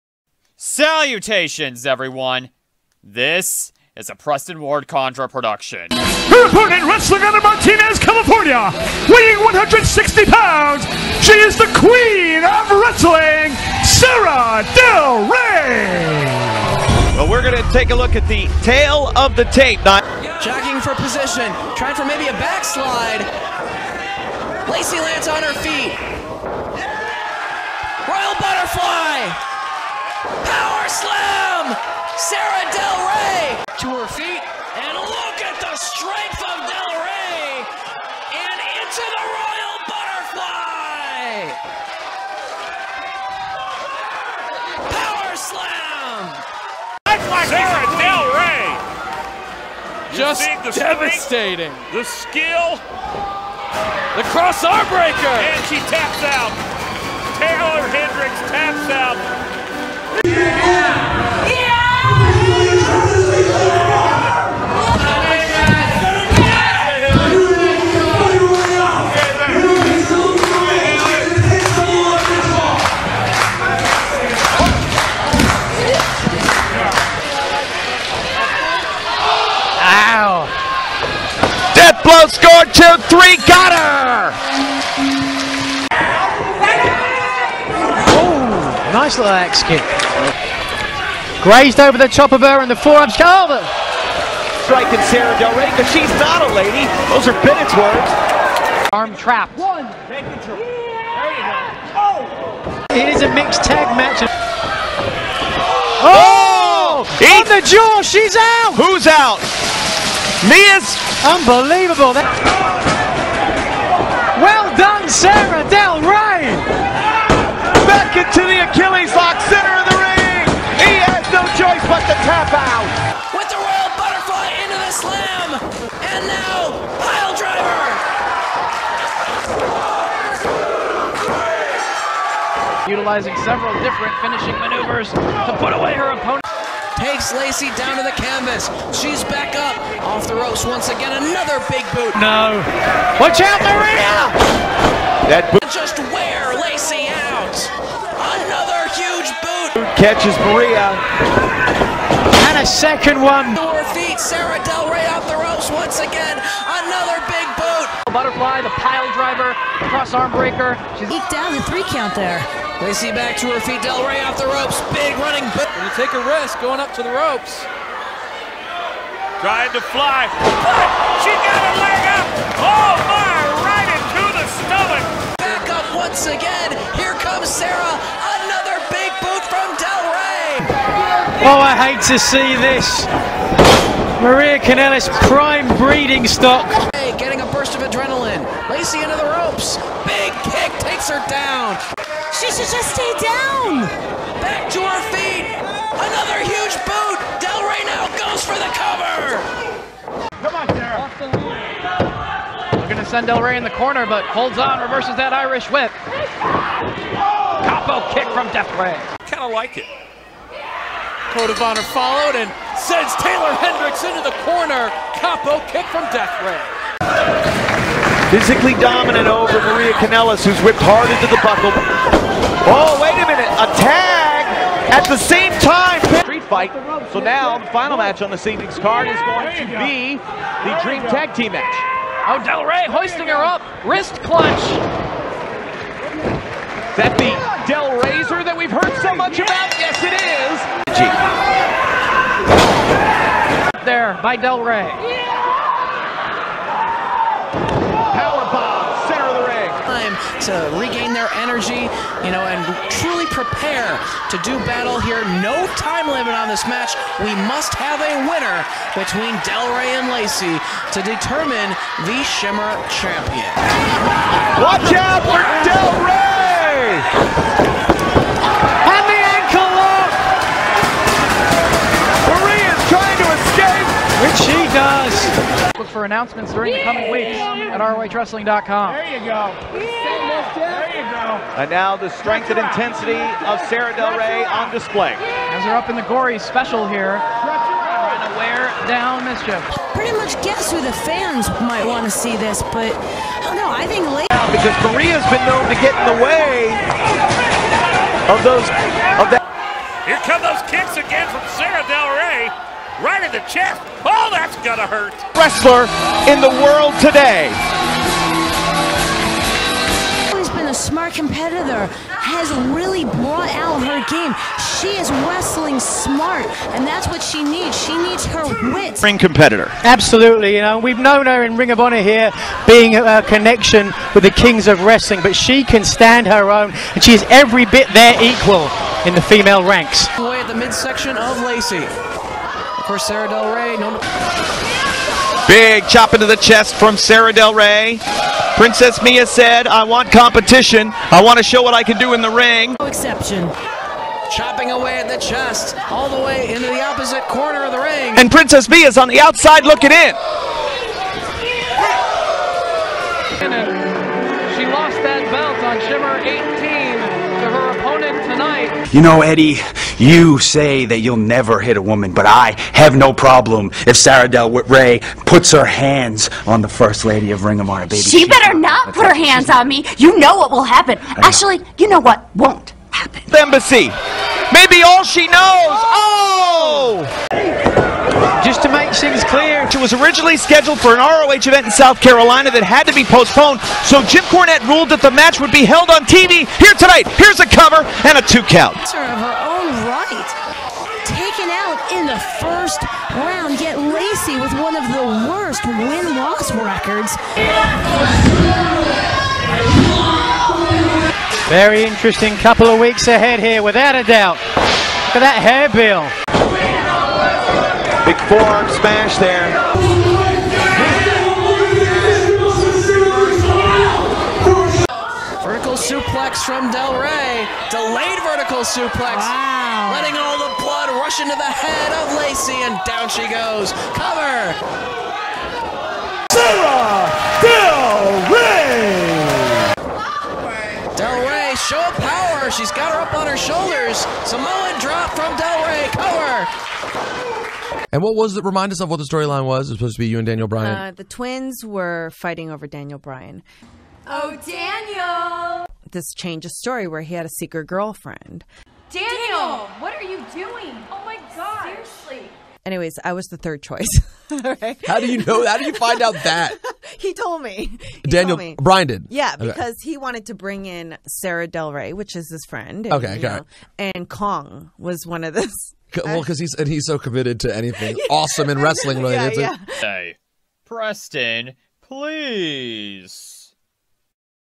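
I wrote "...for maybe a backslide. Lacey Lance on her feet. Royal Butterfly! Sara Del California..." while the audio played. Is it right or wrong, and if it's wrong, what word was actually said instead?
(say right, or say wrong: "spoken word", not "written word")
wrong: "Rey", not "California".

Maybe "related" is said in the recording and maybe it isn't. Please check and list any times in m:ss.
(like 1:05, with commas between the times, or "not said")
7:48.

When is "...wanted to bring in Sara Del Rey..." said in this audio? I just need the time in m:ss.
7:39.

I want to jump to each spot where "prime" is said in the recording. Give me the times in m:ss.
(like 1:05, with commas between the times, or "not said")
3:05.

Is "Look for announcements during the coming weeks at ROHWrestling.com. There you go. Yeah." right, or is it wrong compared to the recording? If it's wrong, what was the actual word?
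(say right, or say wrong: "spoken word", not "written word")
right.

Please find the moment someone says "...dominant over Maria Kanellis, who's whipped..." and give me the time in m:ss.
3:38.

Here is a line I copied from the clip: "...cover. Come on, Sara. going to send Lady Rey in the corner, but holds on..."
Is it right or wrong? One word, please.
wrong.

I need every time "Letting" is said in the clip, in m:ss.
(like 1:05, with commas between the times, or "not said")
6:59.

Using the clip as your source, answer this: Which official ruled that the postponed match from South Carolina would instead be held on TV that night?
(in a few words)
Jim Cornette.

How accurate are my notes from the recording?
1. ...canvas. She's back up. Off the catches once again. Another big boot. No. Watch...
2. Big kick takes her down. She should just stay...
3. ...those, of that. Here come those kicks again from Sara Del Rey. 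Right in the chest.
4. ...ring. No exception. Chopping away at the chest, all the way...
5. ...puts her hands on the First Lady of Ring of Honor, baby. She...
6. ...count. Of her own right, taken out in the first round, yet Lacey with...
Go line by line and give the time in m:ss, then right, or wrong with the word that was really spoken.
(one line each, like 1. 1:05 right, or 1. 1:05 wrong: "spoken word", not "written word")
1. 2:18 wrong: "ropes", not "catches"
2. 3:10 right
3. 4:58 right
4. 5:42 right
5. 6:05 right
6. 6:28 right.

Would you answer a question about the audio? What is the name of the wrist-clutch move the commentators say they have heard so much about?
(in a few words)
Del Razor.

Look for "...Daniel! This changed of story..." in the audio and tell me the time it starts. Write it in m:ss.
7:24.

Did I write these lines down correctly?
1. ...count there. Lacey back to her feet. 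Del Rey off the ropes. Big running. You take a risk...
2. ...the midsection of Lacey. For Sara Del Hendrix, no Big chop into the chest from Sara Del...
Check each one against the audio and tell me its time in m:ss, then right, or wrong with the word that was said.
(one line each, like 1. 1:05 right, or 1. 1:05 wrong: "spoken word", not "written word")
1. 2:41 right
2. 5:30 wrong: "Rey", not "Hendrix".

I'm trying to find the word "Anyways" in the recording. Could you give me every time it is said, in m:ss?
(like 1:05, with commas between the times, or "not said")
7:32.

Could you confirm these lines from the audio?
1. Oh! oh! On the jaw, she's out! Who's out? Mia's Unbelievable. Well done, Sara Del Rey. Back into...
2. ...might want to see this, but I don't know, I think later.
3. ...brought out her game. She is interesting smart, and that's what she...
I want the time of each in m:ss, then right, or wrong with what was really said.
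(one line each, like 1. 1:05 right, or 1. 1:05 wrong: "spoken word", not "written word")
1. 1:46 right
2. 4:51 right
3. 5:13 wrong: "wrestling", not "interesting".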